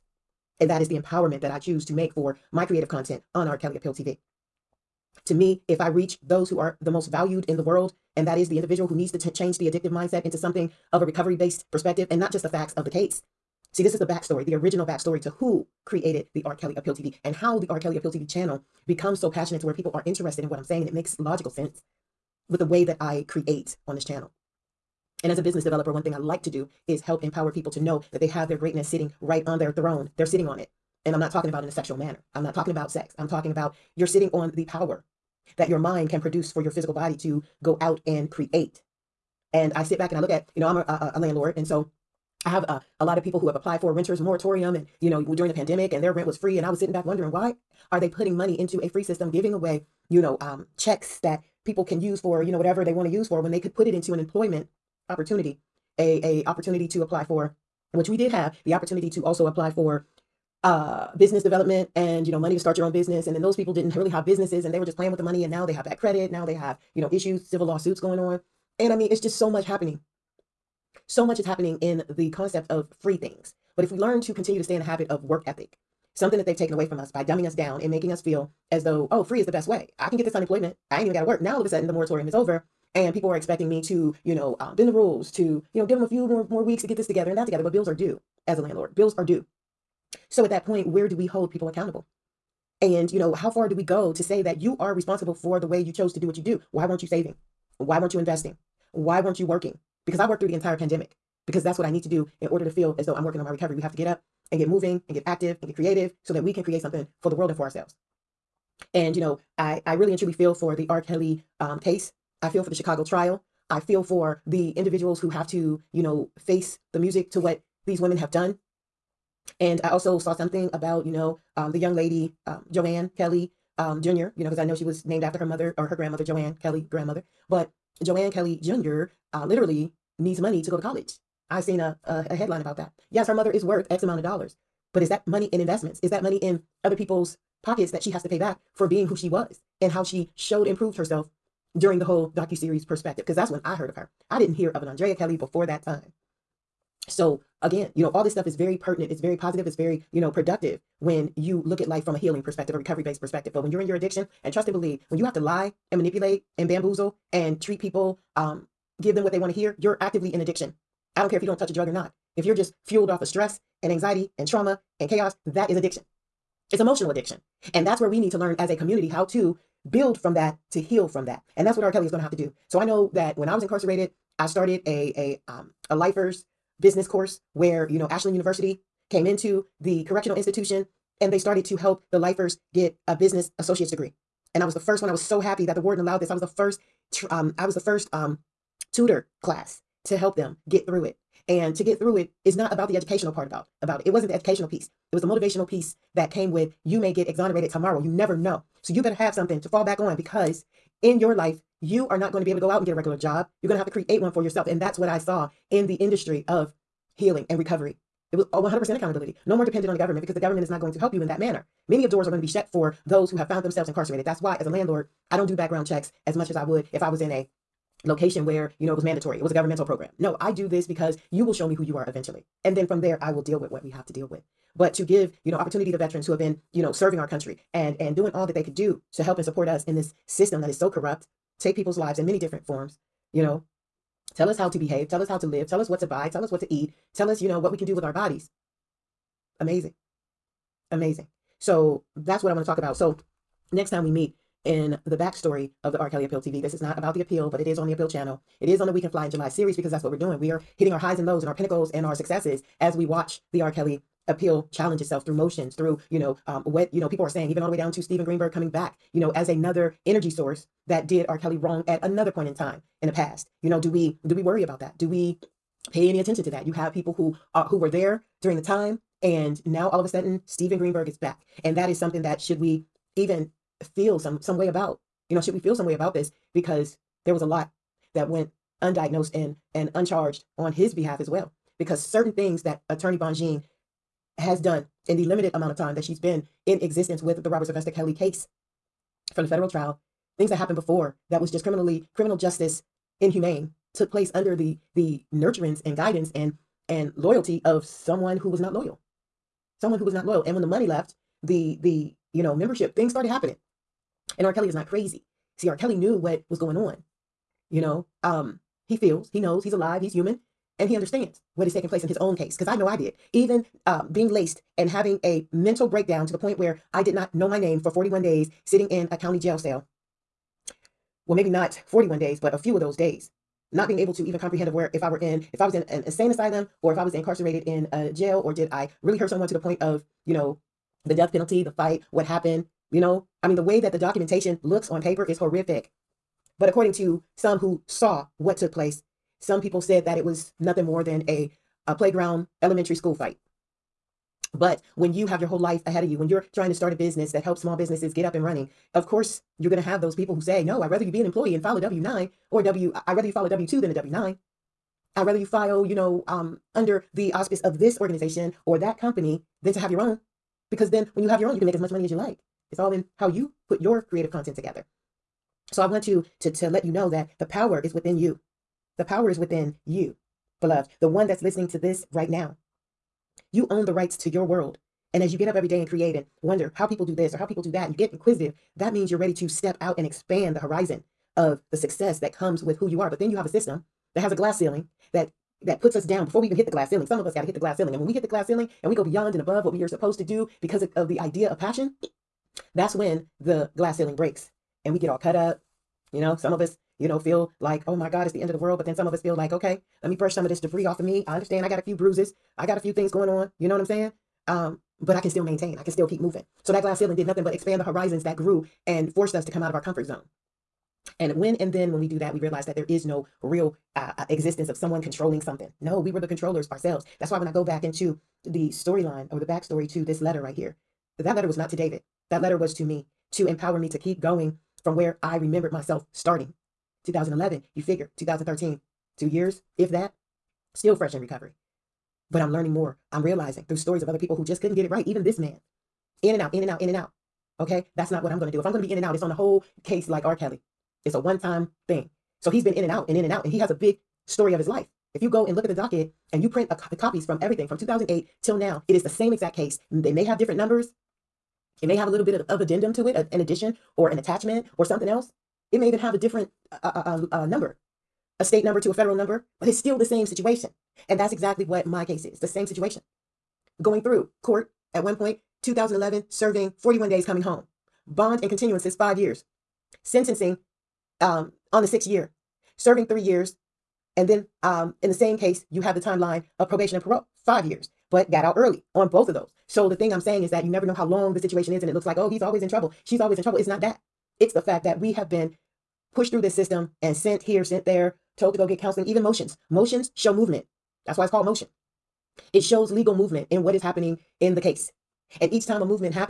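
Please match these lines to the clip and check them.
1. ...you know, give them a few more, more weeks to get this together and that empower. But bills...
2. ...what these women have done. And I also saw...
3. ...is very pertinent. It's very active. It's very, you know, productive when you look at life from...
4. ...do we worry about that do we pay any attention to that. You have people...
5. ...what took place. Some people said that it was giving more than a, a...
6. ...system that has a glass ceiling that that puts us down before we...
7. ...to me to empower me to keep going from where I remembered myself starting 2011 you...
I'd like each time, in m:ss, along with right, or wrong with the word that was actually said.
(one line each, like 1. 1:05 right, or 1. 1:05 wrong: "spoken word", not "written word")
1. 1:25 wrong: "together", not "empower"
2. 1:57 right
3. 2:28 wrong: "positive", not "active"
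4. 4:24 right
5. 5:38 wrong: "nothing", not "giving"
6. 6:23 right
7. 7:02 right.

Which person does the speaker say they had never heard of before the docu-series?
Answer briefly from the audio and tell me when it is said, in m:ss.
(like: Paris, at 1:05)
Andrea Kelly, at 2:24.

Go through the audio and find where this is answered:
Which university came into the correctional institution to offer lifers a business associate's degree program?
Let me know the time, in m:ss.
2:58.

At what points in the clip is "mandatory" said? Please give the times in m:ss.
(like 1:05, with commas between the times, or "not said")
3:39.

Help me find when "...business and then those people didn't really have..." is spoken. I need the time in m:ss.
1:02.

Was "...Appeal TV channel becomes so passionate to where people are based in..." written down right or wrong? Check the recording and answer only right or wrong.
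wrong.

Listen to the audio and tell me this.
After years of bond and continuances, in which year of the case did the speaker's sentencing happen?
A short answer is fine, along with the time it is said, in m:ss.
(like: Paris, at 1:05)
the sixth year, at 7:51.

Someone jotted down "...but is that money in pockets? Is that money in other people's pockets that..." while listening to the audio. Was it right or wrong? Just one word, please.
wrong.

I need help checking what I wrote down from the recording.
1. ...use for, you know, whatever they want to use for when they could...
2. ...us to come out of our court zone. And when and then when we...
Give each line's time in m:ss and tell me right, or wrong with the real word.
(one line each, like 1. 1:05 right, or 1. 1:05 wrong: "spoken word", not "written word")
1. 0:52 right
2. 6:49 wrong: "comfort", not "court".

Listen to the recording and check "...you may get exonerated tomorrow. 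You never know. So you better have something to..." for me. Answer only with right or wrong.
right.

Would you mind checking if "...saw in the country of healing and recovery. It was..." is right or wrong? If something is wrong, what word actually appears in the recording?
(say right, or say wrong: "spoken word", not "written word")
wrong: "industry", not "country".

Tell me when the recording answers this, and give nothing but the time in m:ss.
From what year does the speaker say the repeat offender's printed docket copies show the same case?
7:27.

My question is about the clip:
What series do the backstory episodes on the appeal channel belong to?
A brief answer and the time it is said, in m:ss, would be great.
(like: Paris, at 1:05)
We Can Fly in July, at 4:08.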